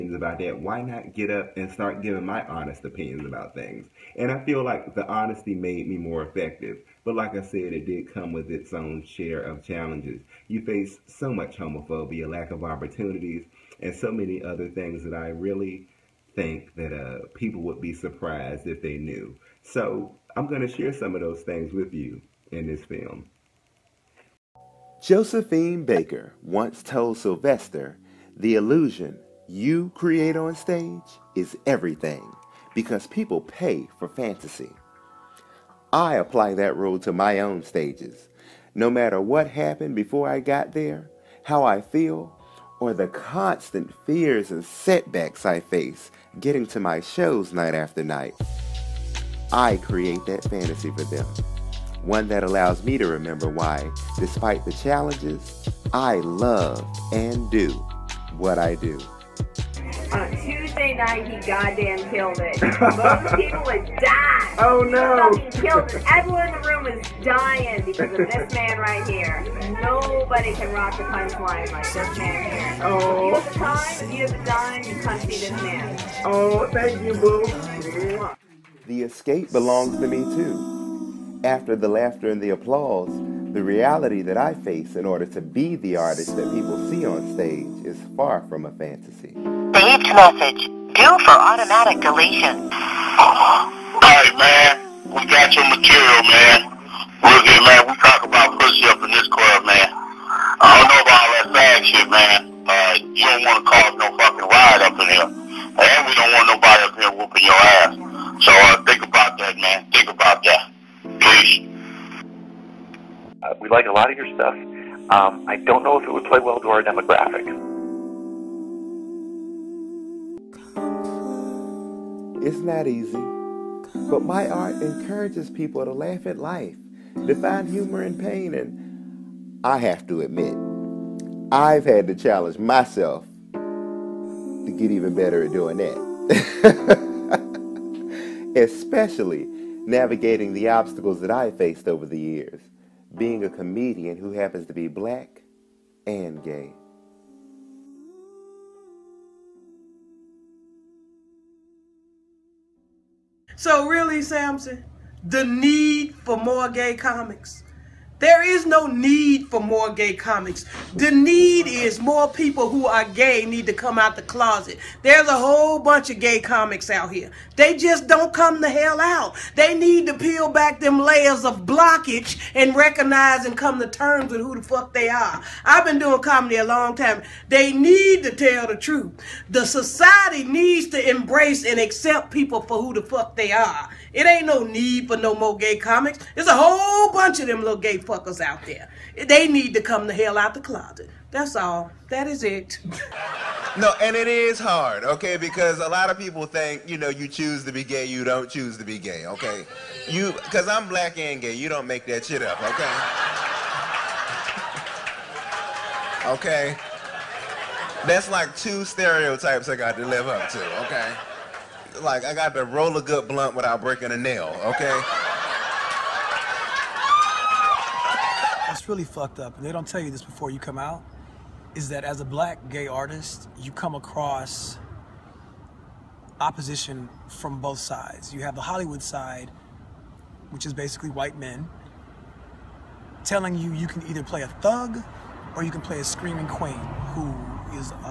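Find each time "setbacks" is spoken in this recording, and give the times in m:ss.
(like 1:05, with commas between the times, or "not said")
0:44.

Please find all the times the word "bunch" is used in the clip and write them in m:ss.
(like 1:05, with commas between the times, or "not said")
2:45, 3:07.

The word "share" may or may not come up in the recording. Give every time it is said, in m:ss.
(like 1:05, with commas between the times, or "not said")
0:09, 0:20.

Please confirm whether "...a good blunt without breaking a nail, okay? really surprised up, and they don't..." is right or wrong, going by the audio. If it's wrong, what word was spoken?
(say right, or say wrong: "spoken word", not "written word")
wrong: "fucked", not "surprised".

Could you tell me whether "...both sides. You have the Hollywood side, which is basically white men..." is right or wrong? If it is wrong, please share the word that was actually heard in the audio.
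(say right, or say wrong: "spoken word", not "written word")
right.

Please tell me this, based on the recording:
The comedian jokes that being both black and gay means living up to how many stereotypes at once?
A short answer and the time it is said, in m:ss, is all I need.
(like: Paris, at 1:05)
2, at 3:28.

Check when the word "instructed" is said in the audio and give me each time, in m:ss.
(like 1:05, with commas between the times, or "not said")
not said.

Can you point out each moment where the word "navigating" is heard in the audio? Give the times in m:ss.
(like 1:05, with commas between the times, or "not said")
2:19.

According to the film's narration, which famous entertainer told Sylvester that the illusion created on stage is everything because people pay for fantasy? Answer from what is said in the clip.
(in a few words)
Josephine Baker.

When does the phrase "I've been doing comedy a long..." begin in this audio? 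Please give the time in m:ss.
2:55.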